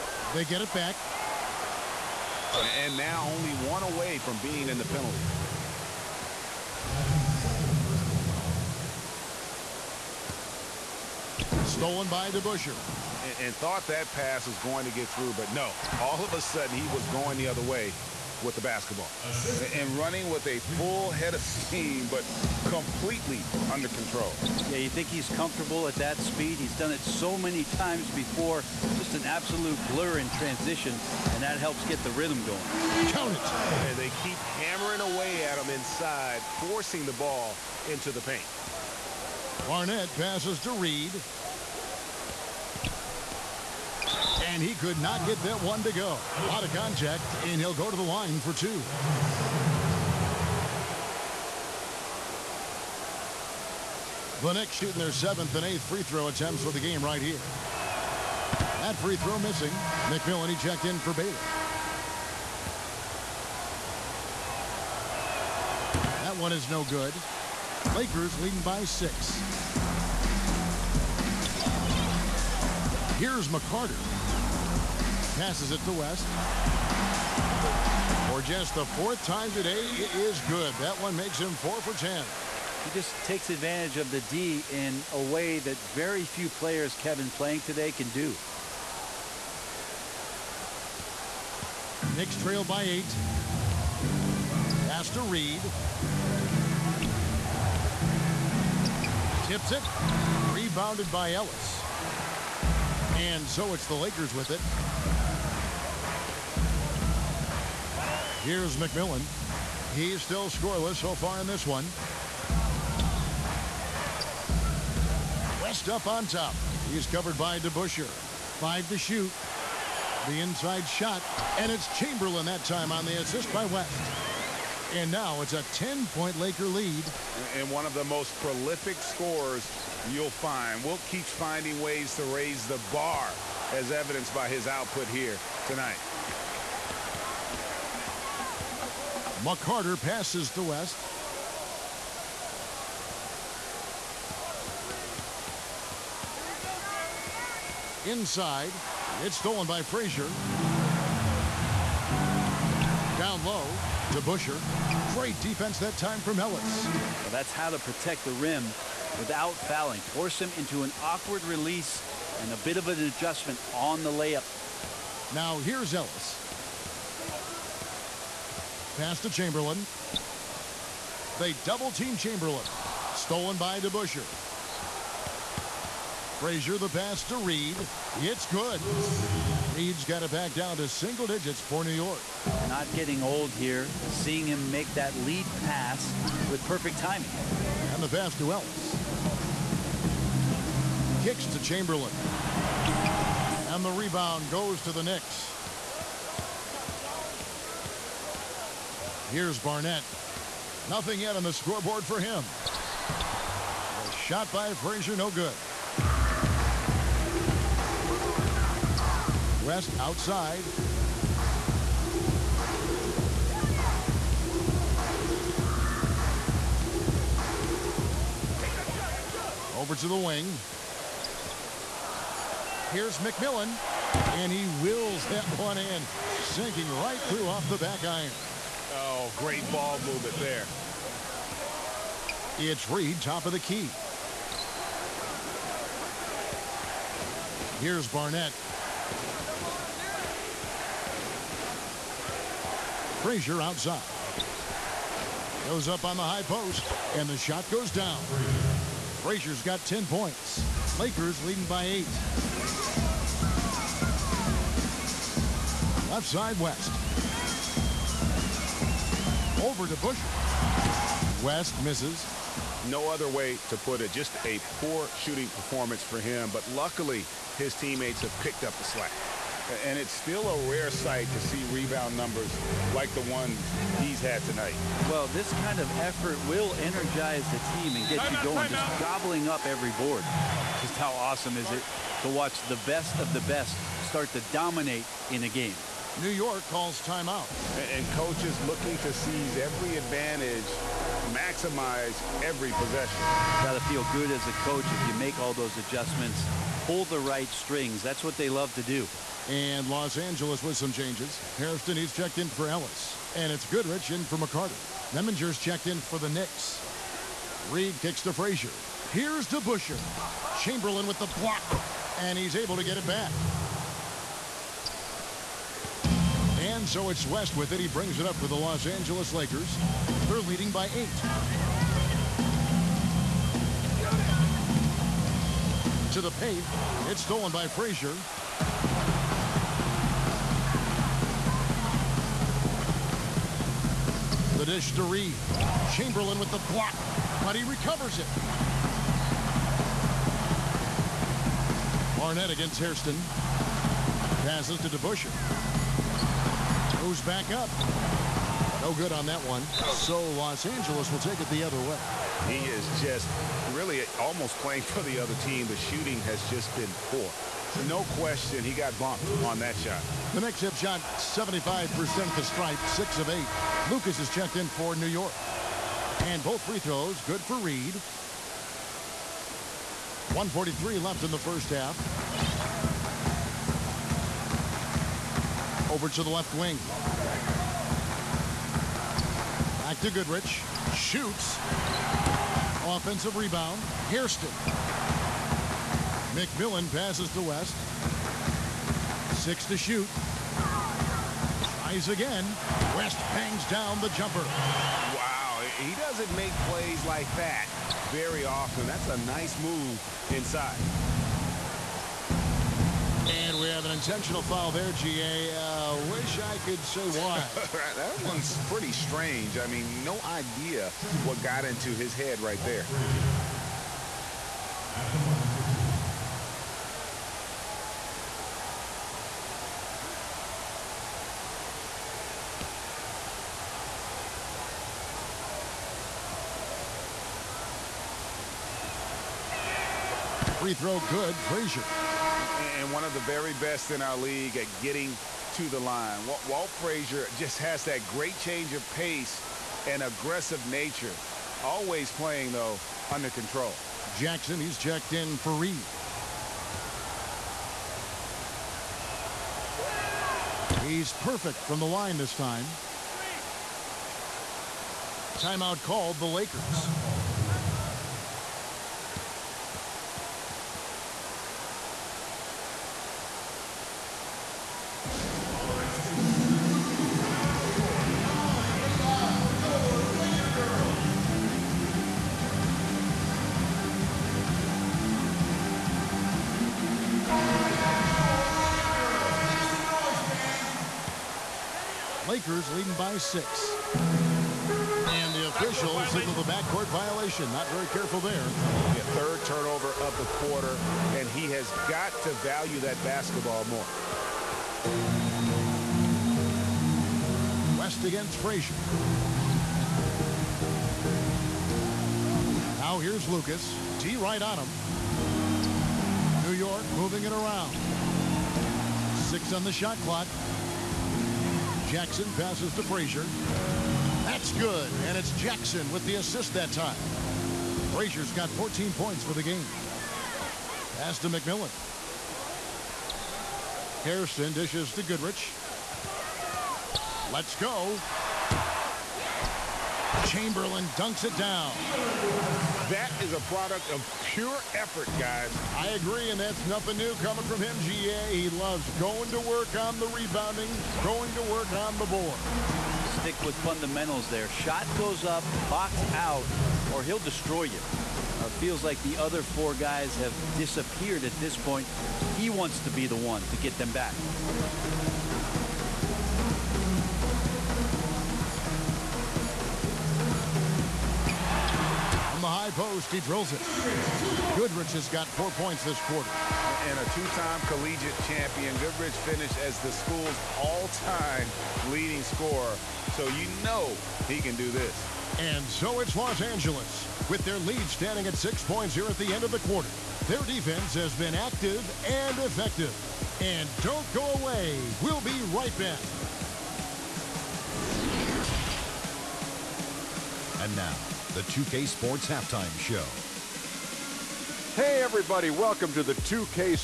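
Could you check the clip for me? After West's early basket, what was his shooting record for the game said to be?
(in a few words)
4 for 10.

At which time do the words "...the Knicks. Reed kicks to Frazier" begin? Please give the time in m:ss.
5:06.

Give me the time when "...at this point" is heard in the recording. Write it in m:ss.
9:11.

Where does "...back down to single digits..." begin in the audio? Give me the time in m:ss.
3:00.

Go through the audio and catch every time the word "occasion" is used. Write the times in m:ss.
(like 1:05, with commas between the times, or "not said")
not said.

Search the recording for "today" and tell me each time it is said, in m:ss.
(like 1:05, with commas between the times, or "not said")
1:19, 1:27.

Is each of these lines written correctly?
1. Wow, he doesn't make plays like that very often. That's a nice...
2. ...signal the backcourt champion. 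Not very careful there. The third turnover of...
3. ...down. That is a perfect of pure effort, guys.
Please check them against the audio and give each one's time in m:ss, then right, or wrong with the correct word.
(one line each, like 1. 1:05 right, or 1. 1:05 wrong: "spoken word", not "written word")
1. 6:34 right
2. 8:06 wrong: "violation", not "champion"
3. 8:51 wrong: "product", not "perfect".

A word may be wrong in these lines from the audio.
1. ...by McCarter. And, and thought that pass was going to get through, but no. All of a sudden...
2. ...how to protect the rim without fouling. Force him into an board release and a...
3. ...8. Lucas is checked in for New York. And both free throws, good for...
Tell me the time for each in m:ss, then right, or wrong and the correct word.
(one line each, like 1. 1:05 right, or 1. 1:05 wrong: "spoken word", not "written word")
1. 0:12 wrong: "DeBusschere", not "McCarter"
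2. 2:37 wrong: "awkward", not "board"
3. 6:03 right.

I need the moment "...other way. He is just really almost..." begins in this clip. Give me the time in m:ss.
5:51.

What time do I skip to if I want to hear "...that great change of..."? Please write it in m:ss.
7:17.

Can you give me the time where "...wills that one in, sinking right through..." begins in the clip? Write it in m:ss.
3:44.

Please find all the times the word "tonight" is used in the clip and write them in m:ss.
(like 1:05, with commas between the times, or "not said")
2:15, 4:34.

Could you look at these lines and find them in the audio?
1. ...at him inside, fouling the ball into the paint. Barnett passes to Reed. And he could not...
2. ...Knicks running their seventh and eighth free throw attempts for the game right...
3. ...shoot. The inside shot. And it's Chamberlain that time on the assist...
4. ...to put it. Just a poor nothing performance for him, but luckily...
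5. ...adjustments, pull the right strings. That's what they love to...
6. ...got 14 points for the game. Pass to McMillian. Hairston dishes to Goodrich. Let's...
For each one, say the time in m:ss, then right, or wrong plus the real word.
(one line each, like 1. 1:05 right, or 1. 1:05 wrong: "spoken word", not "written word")
1. 0:35 wrong: "forcing", not "fouling"
2. 0:54 wrong: "shooting", not "running"
3. 1:58 right
4. 4:23 wrong: "shooting", not "nothing"
5. 4:55 right
6. 8:38 right.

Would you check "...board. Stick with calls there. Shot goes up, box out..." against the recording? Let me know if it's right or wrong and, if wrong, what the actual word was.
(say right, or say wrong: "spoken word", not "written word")
wrong: "fundamentals", not "calls".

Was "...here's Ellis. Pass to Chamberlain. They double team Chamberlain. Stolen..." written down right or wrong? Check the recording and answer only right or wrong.
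right.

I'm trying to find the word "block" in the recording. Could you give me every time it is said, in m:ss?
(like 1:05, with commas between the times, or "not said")
5:11, 5:36.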